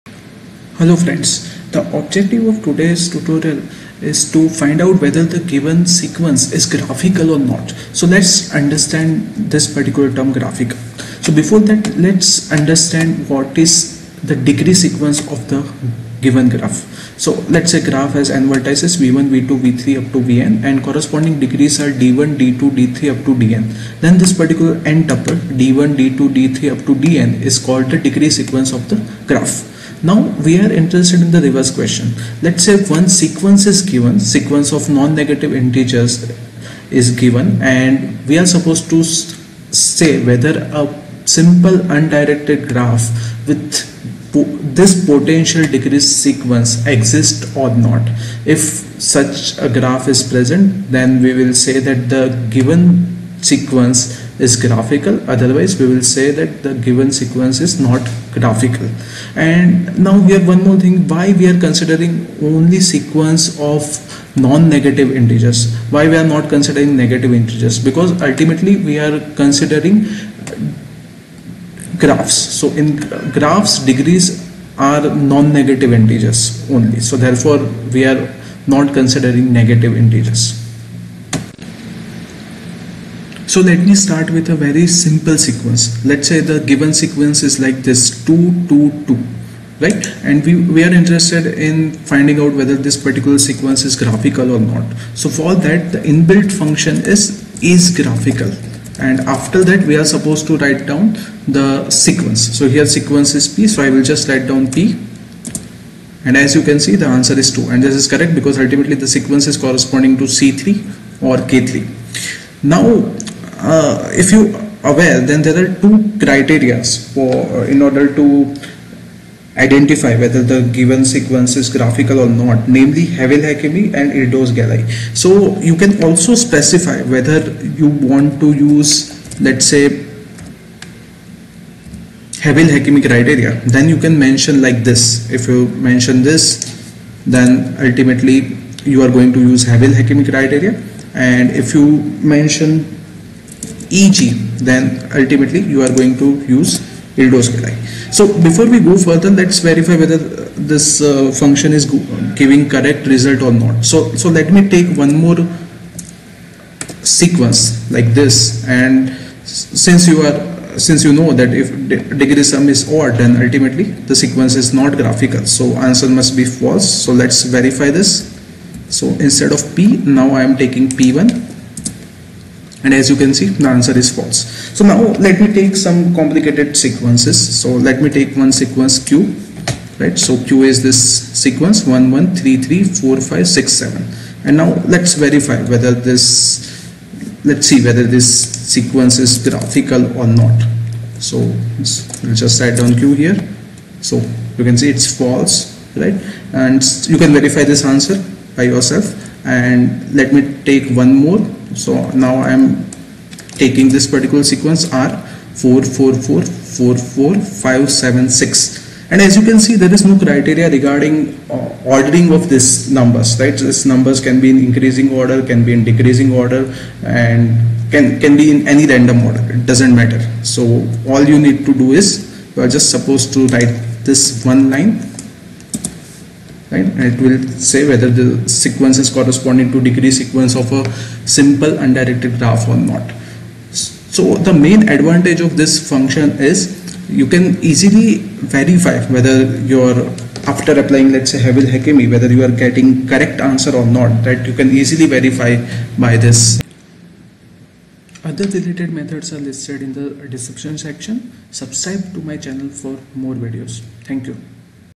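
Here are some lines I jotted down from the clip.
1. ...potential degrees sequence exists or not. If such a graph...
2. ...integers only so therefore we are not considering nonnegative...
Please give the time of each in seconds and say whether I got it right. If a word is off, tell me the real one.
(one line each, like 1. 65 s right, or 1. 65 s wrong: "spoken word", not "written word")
1. 45 s right
2. 76 s wrong: "negative", not "nonnegative".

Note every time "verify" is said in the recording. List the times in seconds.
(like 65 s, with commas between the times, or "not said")
149 s, 167 s, 185 s, 197 s, 238 s, 245 s.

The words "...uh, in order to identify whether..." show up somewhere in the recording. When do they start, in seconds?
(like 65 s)
117 s.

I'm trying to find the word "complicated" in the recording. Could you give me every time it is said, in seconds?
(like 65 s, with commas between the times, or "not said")
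176 s.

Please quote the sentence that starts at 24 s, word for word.
Then this particular n tuple d1, d2, d3 up to dn is called the degree sequence of the graph.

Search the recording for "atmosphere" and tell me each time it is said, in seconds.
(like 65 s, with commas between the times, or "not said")
not said.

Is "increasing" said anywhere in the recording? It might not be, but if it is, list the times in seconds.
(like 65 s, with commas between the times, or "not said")
214 s.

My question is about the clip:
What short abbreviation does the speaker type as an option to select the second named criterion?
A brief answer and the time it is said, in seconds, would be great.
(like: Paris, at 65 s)
EG, at 143 s.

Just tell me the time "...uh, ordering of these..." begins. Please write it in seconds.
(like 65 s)
211 s.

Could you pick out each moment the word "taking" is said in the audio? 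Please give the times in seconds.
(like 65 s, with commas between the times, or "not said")
170 s, 203 s.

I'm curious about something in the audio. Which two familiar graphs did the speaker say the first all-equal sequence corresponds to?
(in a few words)
C3 or K3.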